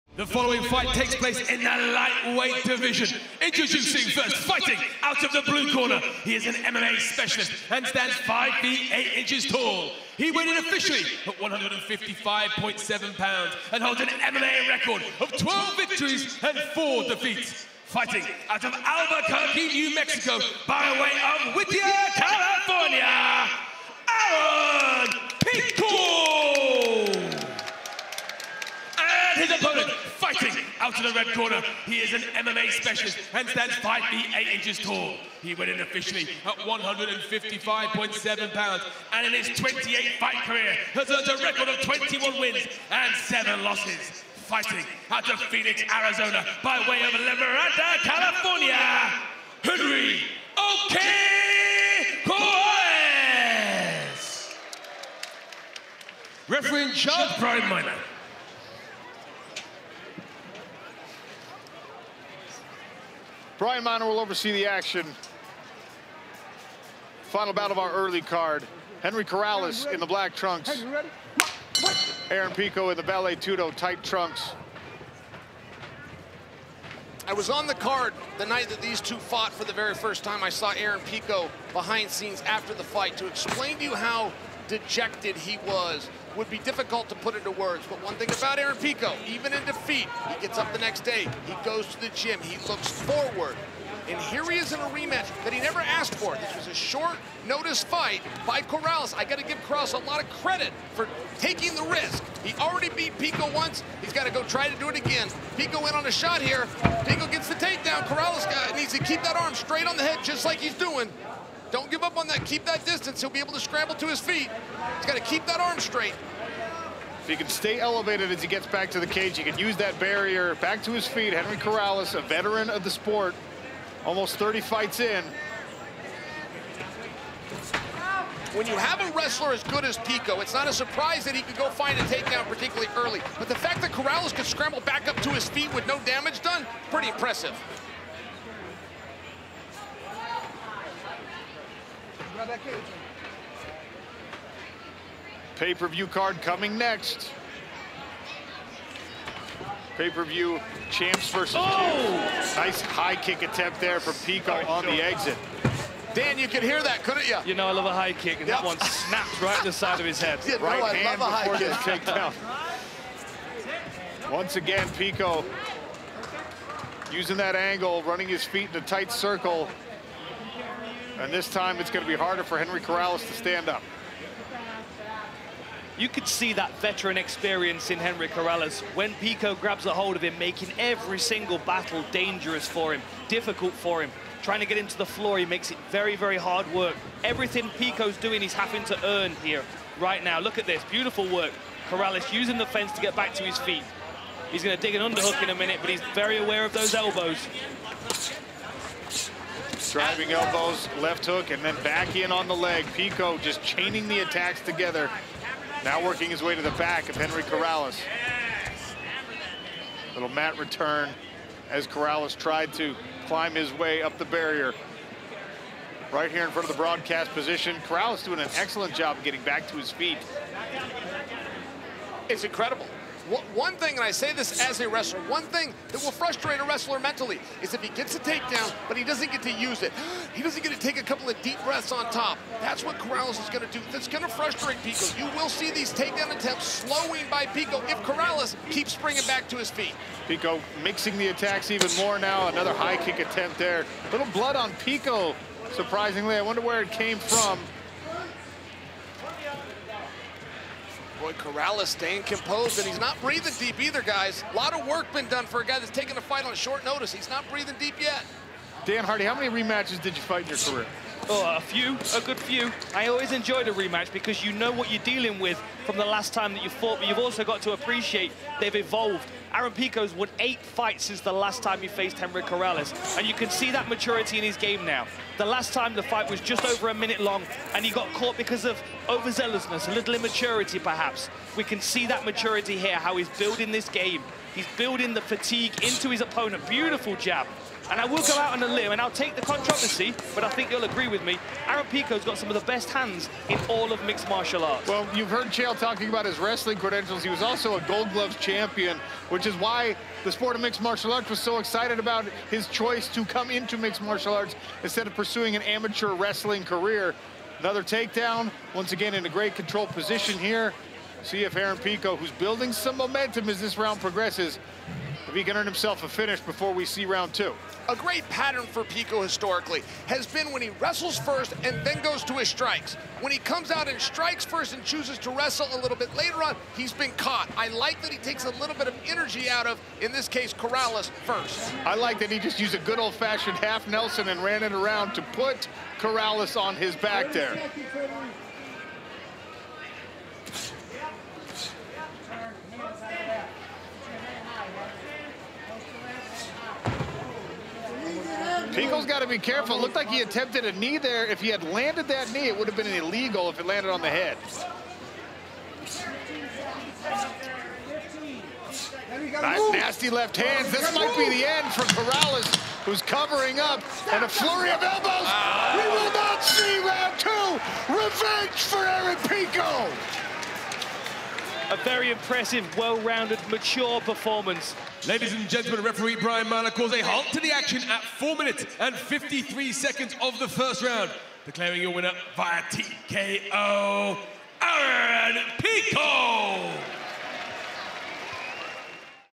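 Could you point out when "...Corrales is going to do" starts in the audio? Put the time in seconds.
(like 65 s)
232 s.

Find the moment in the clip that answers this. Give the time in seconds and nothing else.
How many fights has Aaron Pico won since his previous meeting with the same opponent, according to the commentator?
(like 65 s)
270 s.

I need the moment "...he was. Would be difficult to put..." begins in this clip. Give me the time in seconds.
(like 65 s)
85 s.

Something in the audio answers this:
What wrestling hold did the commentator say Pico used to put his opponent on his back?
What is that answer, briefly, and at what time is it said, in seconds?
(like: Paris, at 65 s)
Half Nelson, at 333 s.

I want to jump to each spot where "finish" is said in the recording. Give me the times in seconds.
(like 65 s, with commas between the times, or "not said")
316 s.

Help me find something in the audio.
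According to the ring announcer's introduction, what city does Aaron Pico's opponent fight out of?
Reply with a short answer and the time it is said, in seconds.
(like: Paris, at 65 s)
Phoenix, Arizona, at 45 s.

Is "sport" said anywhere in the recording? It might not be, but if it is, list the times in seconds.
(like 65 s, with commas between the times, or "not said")
122 s, 300 s.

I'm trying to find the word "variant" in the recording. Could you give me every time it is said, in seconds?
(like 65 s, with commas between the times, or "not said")
not said.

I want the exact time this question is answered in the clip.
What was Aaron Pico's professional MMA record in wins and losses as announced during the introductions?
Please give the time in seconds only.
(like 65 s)
15 s.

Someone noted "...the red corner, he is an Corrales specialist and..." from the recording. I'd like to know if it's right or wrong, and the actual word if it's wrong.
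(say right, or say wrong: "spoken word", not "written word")
wrong: "MMA", not "Corrales".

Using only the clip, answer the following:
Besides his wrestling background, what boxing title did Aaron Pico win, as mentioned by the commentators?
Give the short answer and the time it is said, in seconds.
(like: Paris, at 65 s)
Gold Gloves, at 297 s.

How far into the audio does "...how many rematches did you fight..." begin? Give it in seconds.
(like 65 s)
259 s.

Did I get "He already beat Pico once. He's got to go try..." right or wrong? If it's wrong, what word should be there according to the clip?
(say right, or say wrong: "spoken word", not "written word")
right.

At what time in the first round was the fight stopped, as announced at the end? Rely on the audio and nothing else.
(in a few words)
4:53.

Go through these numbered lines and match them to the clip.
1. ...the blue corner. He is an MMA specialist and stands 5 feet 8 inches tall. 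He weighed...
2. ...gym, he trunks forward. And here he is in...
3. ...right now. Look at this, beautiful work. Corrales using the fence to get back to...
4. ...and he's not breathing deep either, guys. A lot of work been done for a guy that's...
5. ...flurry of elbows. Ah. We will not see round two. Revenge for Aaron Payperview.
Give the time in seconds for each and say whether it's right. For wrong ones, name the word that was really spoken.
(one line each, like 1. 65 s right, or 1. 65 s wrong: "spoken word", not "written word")
1. 5 s right
2. 92 s wrong: "looks", not "trunks"
3. 189 s right
4. 252 s right
5. 364 s wrong: "Pico", not "Payperview".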